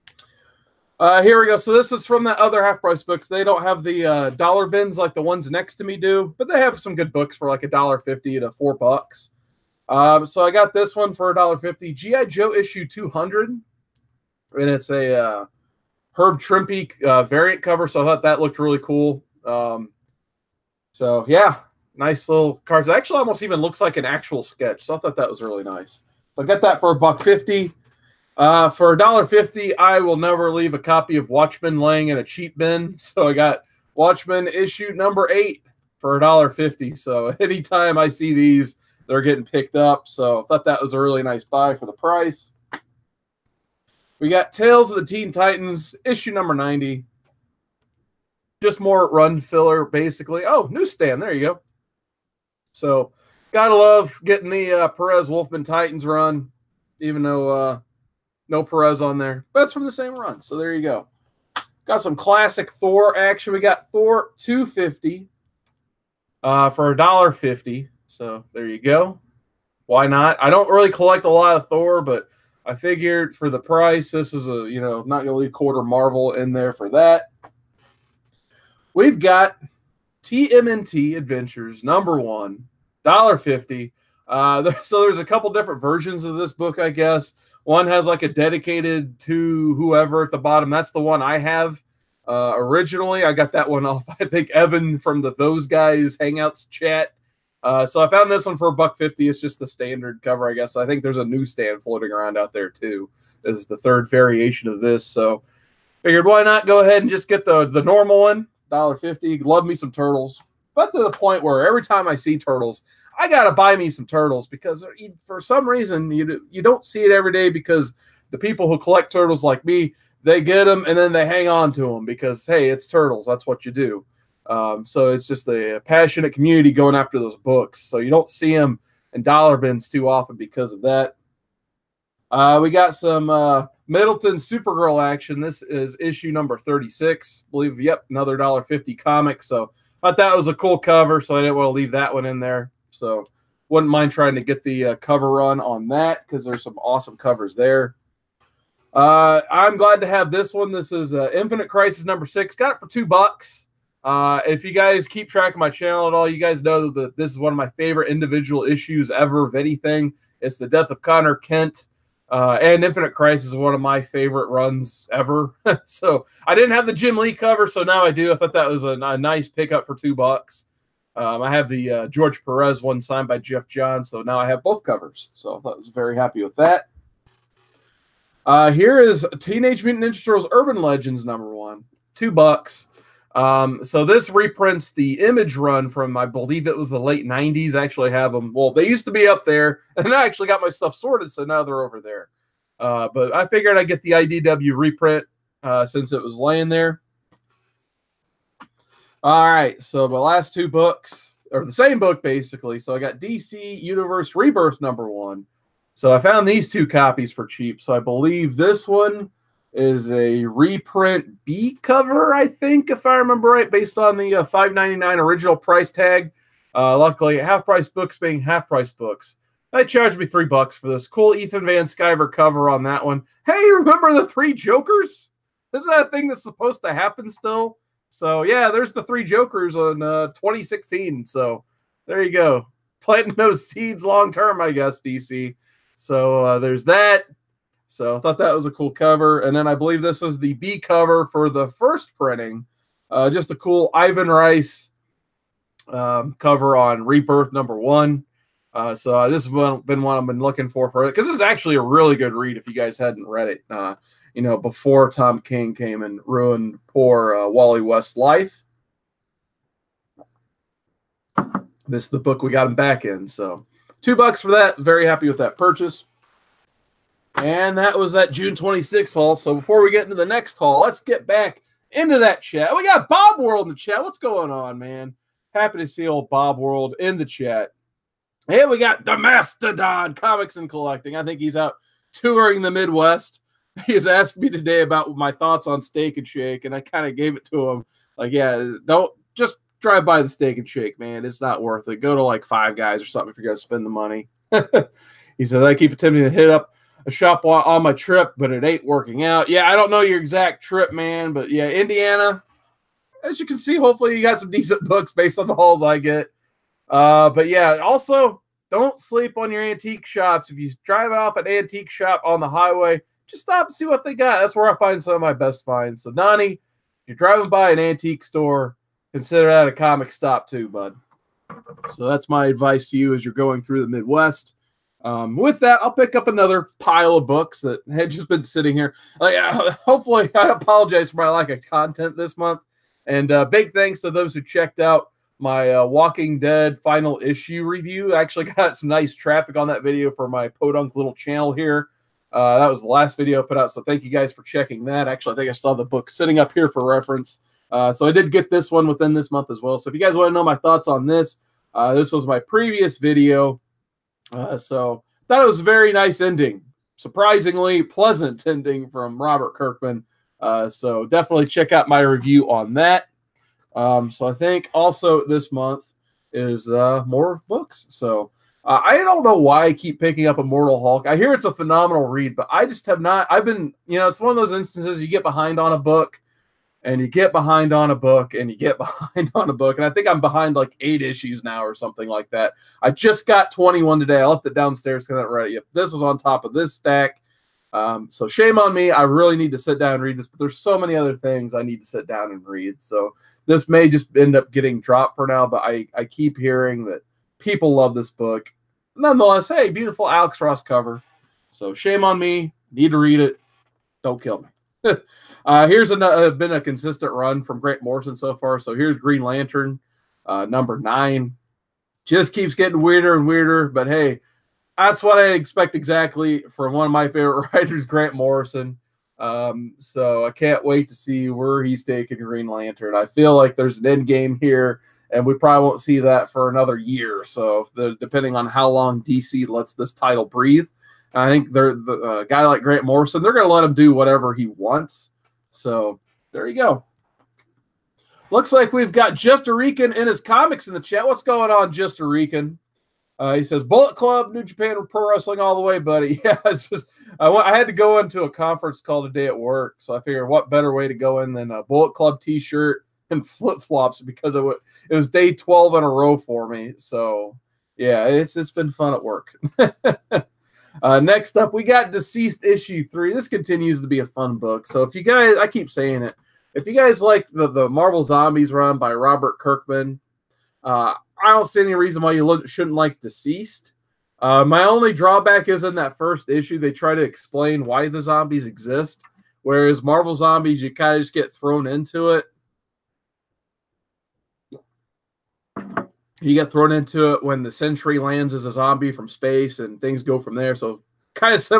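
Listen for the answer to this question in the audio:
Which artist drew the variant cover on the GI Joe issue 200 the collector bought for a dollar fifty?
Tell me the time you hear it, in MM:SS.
00:16.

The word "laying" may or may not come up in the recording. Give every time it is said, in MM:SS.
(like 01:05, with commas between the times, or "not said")
00:31, 03:16.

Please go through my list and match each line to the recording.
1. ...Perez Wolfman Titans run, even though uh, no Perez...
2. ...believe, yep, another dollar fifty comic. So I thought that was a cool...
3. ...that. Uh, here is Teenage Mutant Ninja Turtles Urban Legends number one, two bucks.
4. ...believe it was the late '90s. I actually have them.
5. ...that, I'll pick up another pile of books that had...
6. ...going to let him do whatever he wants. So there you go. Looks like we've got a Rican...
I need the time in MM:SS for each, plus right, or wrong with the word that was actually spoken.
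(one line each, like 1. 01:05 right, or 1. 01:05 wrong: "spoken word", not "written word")
1. 00:54 right
2. 02:17 right
3. 02:56 right
4. 03:06 right
5. 05:25 right
6. 07:13 right.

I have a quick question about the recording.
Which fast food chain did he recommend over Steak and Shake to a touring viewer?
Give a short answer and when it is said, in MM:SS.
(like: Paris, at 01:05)
Five Guys, at 04:52.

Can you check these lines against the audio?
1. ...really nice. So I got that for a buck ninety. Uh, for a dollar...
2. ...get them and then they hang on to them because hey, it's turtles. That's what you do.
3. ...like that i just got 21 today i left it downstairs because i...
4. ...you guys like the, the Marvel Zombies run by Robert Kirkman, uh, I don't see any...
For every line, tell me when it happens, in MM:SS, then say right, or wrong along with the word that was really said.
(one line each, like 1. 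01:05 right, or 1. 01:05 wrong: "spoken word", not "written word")
1. 00:25 wrong: "fifty", not "ninety"
2. 02:00 right
3. 06:22 right
4. 07:46 right.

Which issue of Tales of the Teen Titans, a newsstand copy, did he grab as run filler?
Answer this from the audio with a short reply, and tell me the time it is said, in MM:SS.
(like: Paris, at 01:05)
90, at 00:46.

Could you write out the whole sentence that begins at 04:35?
Happy to see old Bob World in the chat.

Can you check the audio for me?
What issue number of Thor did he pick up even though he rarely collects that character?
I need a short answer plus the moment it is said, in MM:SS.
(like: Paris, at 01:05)
250, at 01:03.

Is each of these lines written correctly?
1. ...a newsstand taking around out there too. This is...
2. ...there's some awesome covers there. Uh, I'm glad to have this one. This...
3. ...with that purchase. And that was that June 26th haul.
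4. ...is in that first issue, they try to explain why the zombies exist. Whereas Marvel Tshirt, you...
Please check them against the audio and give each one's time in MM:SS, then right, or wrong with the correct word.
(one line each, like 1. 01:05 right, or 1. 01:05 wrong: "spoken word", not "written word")
1. 01:41 wrong: "floating", not "taking"
2. 02:26 right
3. 04:25 right
4. 07:55 wrong: "Zombies", not "Tshirt".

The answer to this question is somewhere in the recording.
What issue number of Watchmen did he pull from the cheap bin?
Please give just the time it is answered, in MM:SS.
00:33.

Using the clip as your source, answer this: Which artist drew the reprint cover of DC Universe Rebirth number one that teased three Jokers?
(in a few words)
Ethan Van Sciver.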